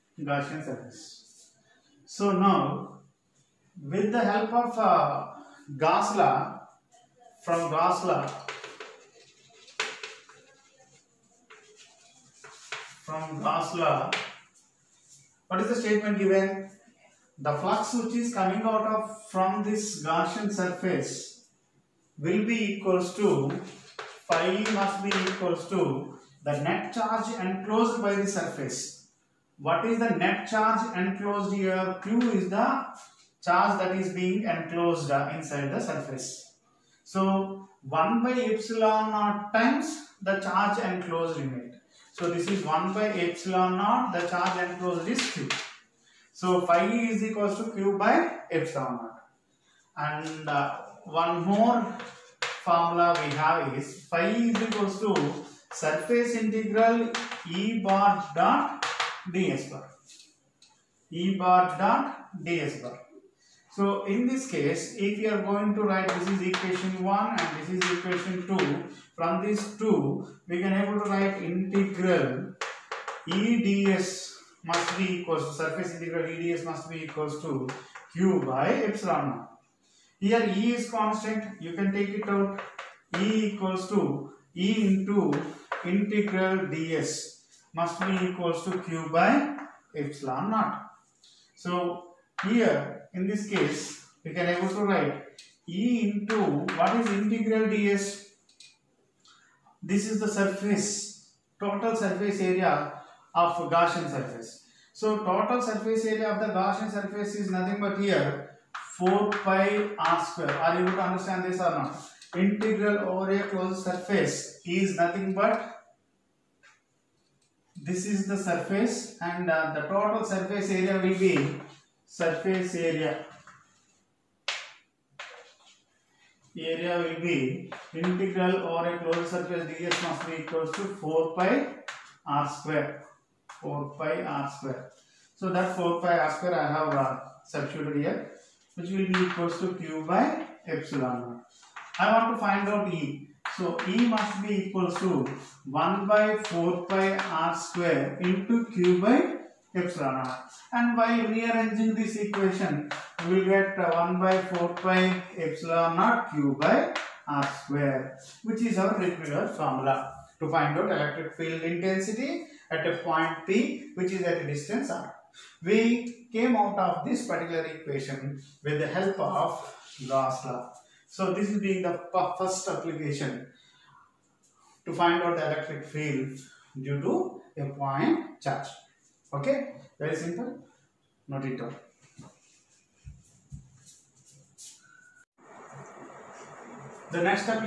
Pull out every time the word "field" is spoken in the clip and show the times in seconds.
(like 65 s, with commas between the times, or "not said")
161 s, 175 s.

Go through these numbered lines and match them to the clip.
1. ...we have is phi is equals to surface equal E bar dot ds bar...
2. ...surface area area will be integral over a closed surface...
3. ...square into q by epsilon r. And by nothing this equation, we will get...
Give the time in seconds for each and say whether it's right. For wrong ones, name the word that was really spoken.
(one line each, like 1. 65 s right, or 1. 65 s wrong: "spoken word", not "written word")
1. 53 s wrong: "integral", not "equal"
2. 122 s right
3. 147 s wrong: "rearranging", not "nothing".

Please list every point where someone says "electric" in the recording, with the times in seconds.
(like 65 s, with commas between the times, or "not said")
160 s, 175 s.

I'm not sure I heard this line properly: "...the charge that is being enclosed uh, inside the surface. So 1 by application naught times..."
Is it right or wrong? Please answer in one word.
wrong.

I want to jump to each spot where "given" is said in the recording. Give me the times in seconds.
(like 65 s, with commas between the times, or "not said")
16 s.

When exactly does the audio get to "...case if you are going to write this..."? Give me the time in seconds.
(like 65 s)
64 s.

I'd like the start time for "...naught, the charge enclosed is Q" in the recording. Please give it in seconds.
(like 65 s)
43 s.